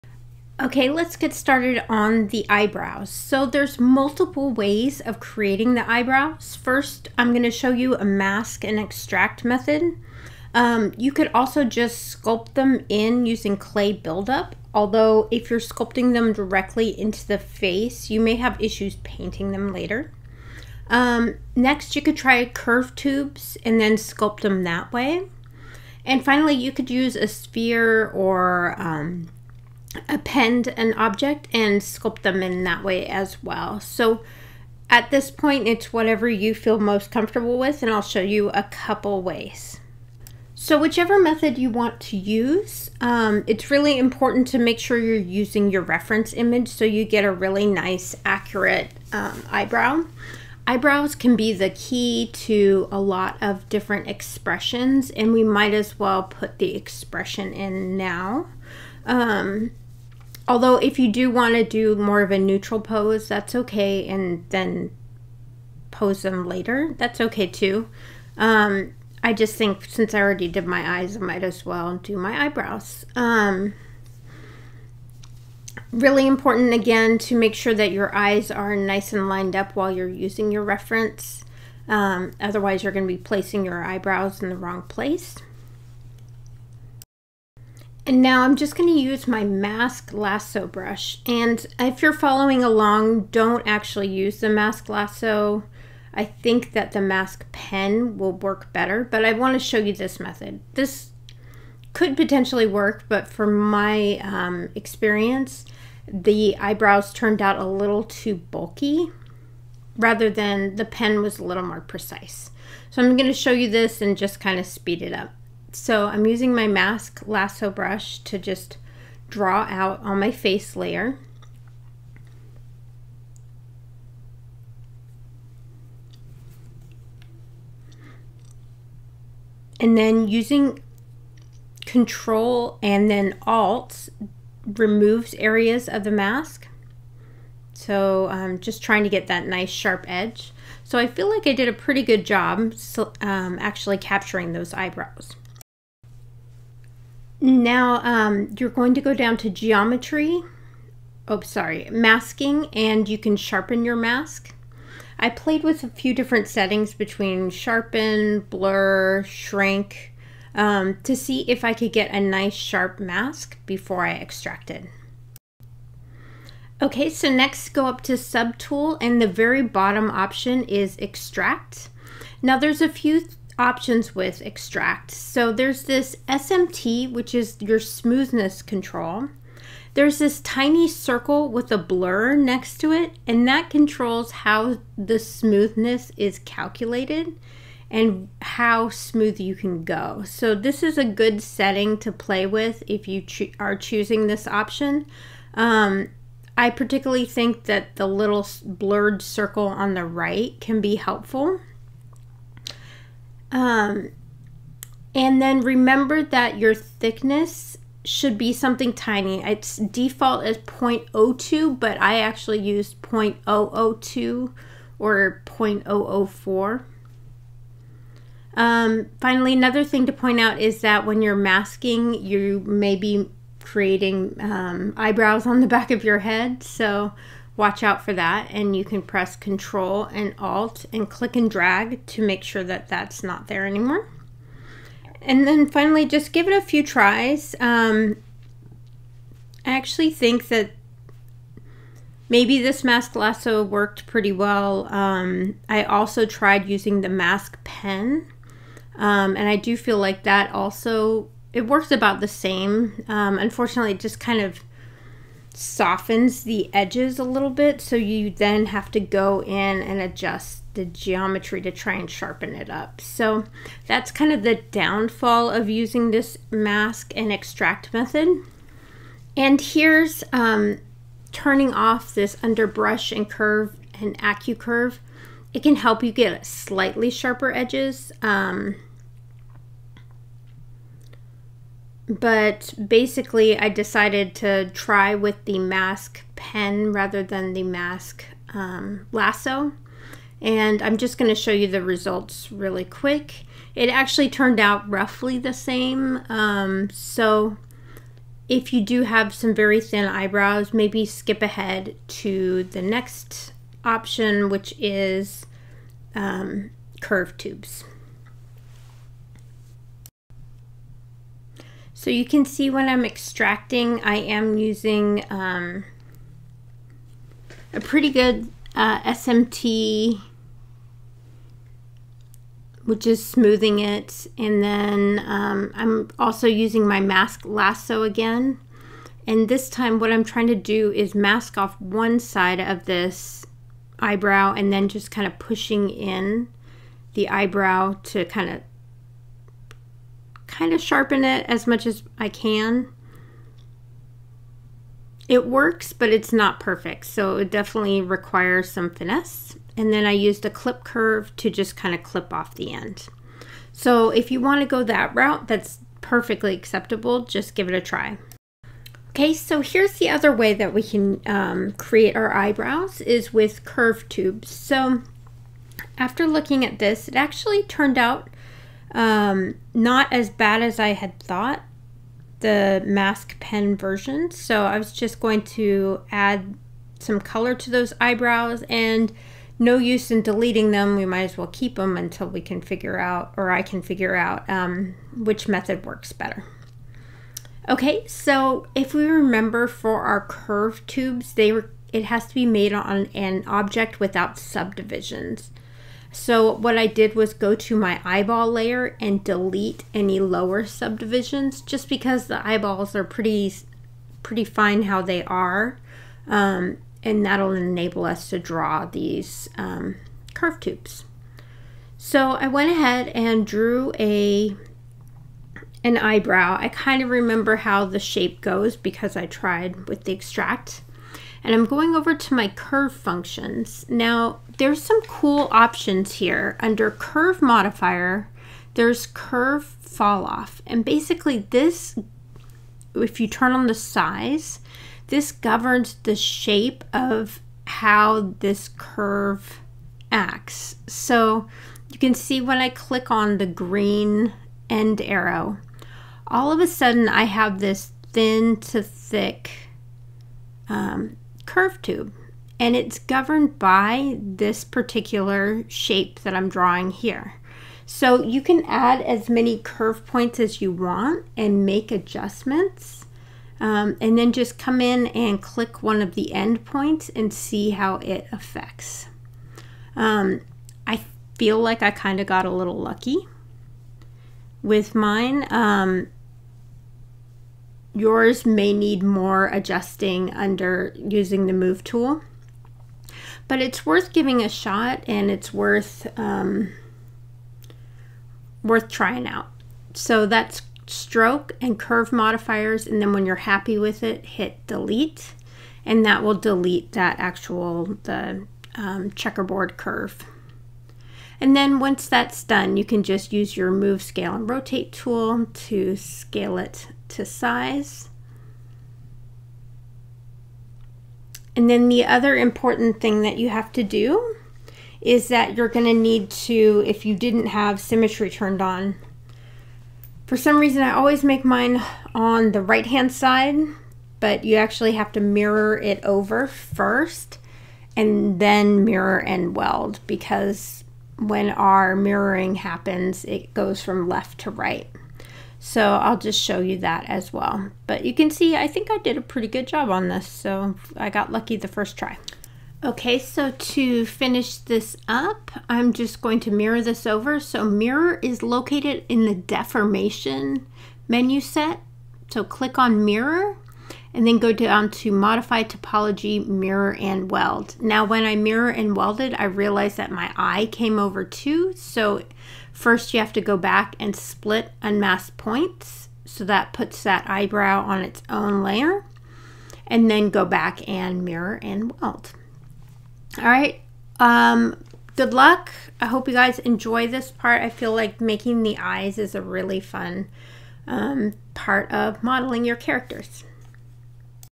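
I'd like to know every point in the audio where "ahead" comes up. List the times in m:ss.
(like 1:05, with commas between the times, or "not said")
5:01, 6:52.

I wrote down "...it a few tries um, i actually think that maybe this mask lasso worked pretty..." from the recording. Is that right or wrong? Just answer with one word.
right.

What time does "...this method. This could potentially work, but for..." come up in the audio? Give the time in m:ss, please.
1:39.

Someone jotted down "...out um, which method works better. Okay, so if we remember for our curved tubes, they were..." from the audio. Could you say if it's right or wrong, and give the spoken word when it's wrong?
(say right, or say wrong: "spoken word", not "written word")
right.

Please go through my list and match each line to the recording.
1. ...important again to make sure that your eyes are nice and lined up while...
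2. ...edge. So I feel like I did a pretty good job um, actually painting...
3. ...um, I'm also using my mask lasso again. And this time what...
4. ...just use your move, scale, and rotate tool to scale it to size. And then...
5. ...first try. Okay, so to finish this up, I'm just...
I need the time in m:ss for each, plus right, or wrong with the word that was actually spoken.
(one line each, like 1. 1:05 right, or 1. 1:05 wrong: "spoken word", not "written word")
1. 1:16 right
2. 2:20 wrong: "capturing", not "painting"
3. 5:25 right
4. 8:23 right
5. 9:01 right.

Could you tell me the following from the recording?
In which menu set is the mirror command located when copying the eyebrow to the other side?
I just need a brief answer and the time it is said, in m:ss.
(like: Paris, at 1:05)
deformation, at 9:09.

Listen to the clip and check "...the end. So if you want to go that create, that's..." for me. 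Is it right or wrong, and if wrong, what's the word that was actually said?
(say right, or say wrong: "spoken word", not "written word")
wrong: "route", not "create".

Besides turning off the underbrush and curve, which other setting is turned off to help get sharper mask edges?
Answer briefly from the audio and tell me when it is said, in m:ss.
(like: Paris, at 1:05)
AccuCurve, at 4:34.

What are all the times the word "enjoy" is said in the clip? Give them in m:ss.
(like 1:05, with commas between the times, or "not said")
9:36.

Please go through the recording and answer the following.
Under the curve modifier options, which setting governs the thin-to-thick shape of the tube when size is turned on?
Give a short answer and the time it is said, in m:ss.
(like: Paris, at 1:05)
curve falloff, at 7:09.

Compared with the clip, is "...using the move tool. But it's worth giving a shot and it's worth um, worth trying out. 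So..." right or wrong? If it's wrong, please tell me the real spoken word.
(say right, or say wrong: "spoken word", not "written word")
right.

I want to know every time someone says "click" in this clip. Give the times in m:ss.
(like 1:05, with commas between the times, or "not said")
3:51, 7:22, 7:45, 9:12.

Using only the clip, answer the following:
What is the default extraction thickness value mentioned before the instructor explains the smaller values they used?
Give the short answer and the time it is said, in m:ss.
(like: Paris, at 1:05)
0.02, at 3:30.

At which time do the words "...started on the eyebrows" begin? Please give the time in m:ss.
0:01.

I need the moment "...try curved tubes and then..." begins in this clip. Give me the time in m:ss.
0:22.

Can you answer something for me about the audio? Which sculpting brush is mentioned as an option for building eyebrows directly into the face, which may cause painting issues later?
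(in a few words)
clay buildup.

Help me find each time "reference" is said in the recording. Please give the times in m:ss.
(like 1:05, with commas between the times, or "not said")
0:45, 1:20.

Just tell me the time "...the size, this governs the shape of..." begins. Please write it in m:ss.
7:13.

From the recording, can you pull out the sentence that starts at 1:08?
Um, I just think since I already did my eyes, I might as well do my eyebrows.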